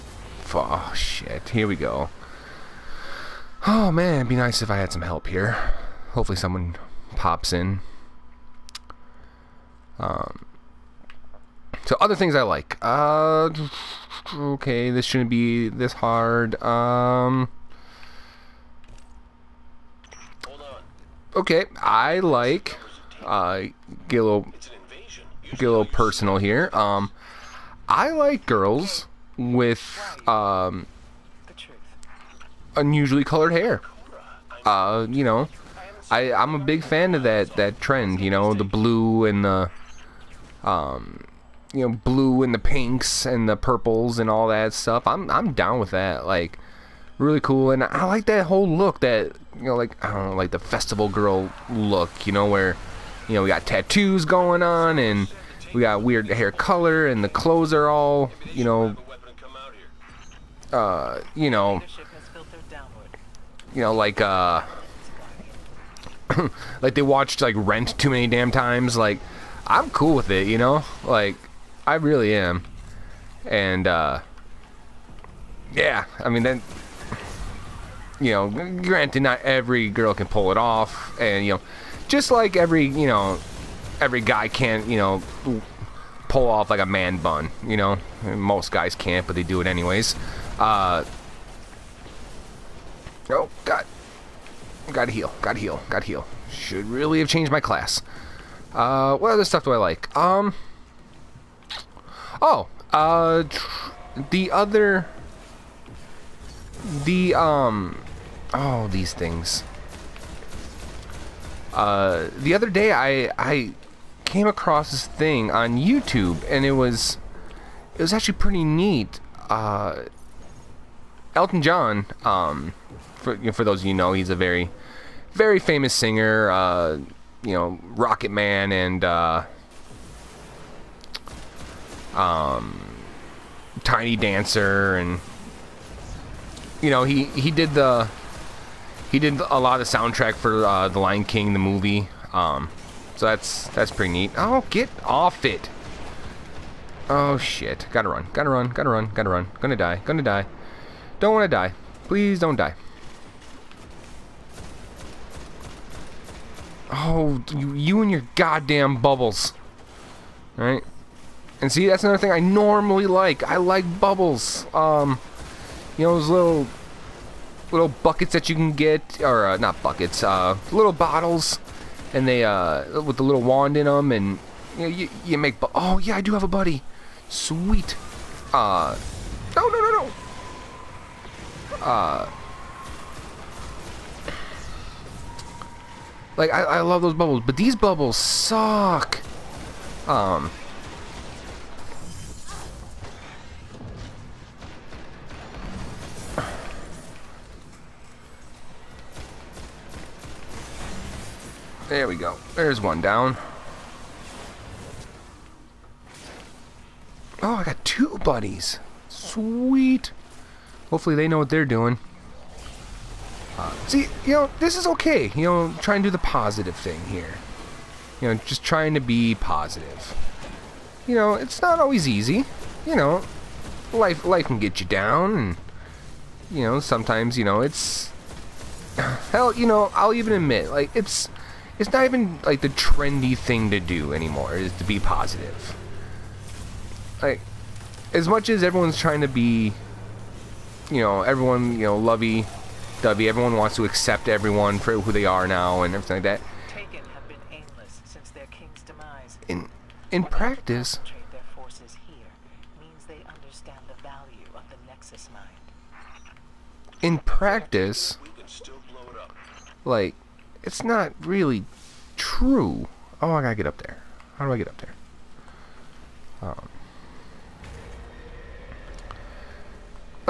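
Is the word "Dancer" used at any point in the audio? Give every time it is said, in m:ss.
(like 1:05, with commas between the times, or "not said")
2:14.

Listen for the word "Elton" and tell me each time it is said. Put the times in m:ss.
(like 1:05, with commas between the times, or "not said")
2:01.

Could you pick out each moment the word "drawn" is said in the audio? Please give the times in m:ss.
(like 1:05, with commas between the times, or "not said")
not said.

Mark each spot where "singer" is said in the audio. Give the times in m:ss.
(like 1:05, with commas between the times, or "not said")
2:05.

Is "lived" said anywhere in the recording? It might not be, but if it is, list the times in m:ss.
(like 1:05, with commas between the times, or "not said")
not said.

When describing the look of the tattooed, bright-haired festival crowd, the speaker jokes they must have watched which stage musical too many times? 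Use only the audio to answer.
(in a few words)
Rent.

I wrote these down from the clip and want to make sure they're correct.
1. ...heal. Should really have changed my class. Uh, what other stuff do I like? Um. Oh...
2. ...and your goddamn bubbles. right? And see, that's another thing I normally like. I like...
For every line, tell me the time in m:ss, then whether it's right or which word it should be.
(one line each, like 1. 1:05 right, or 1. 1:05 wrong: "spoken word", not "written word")
1. 1:36 right
2. 2:38 right.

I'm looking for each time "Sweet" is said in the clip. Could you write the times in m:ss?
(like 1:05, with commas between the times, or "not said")
2:57, 3:29.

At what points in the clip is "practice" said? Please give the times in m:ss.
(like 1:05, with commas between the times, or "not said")
4:10, 4:17.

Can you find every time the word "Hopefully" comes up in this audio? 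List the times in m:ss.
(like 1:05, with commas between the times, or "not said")
0:06, 3:30.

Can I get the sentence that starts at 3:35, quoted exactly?
You know, try and do the positive thing here.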